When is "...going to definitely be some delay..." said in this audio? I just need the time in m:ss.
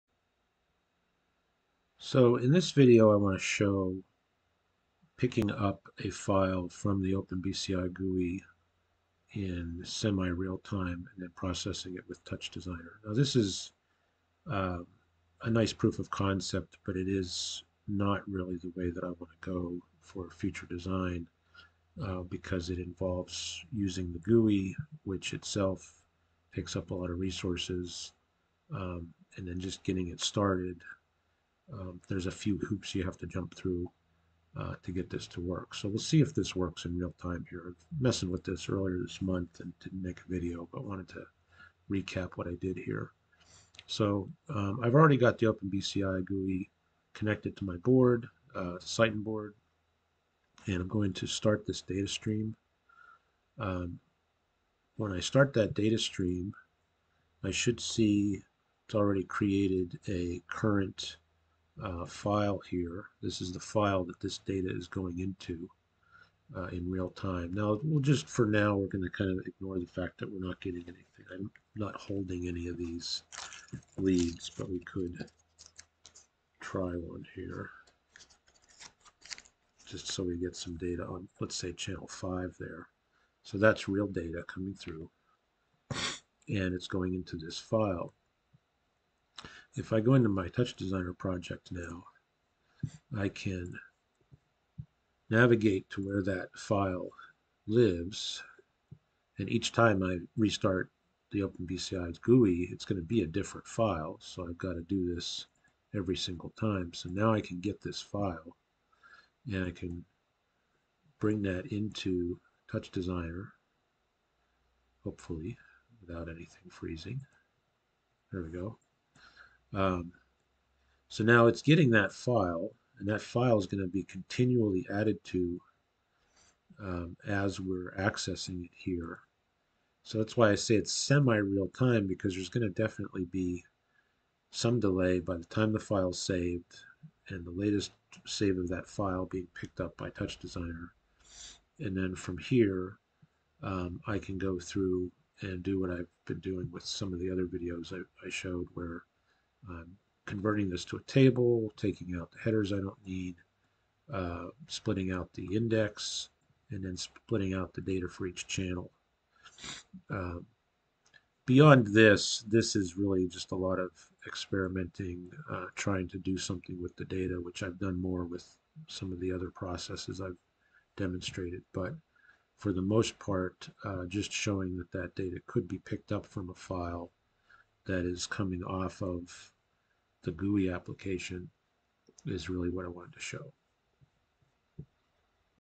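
2:12.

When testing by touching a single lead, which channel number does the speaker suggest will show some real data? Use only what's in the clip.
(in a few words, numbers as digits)
5.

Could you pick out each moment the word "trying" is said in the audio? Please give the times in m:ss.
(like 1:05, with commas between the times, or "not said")
2:45.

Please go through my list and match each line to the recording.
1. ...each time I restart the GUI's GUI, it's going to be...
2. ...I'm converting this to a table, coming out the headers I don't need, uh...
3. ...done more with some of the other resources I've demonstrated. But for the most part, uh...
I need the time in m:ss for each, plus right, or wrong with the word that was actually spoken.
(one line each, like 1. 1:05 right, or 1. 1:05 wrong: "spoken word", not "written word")
1. 1:39 wrong: "OpenBCI", not "GUI"
2. 2:29 wrong: "taking", not "coming"
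3. 2:47 wrong: "processes", not "resources".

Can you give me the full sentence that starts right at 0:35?
So we'll see if this works in real time here.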